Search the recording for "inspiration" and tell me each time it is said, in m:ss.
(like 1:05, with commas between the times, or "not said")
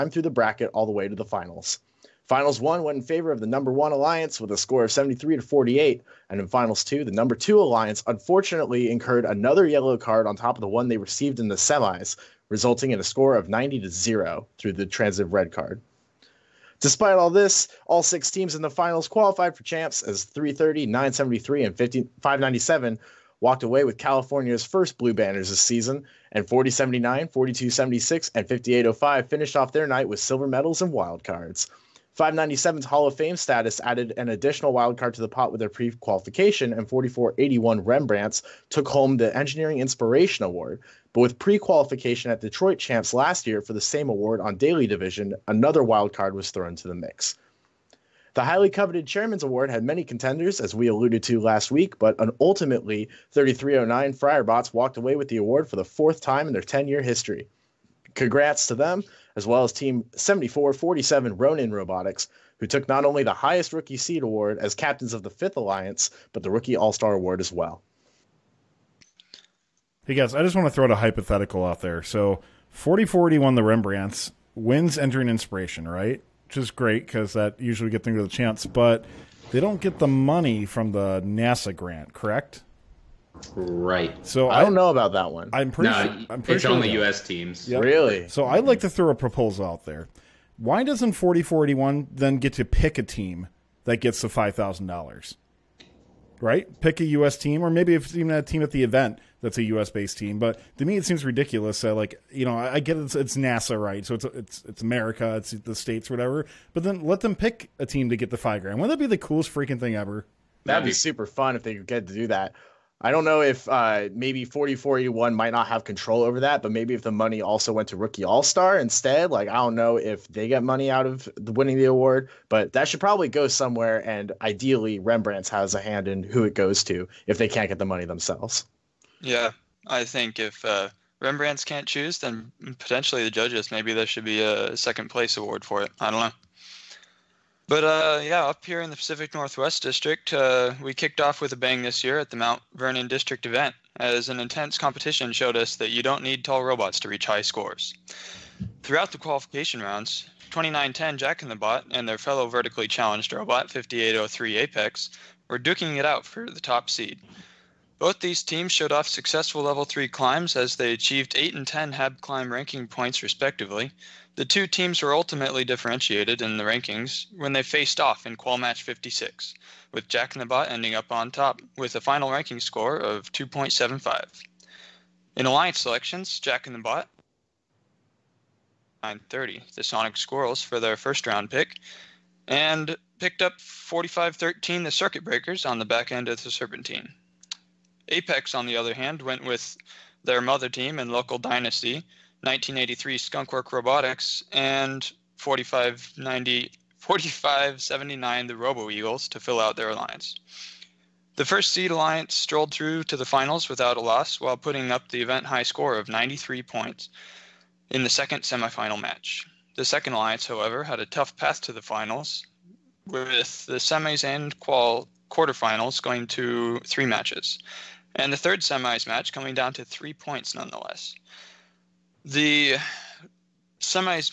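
0:39, 1:15.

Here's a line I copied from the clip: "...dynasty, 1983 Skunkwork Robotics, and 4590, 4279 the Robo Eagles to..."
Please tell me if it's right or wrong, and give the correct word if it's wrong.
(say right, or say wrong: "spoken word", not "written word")
wrong: "4579", not "4279".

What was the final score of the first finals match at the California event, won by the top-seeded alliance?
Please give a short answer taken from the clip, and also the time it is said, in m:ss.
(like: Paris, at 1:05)
73 to 48, at 0:04.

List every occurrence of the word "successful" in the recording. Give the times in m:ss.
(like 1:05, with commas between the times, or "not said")
2:39.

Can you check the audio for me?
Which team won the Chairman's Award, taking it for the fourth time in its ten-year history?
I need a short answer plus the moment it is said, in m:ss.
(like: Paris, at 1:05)
3309 Friarbots, at 0:53.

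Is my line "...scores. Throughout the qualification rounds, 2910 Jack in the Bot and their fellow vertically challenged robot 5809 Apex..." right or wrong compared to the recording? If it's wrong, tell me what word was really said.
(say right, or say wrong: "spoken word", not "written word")
wrong: "5803", not "5809".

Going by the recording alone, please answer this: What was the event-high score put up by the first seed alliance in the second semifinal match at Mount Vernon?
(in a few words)
93 points.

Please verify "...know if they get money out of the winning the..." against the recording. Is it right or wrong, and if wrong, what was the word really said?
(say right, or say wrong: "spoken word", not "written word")
right.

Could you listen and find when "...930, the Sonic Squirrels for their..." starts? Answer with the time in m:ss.
2:59.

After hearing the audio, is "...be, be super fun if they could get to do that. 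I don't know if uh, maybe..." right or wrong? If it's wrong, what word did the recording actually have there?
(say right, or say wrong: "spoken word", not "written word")
right.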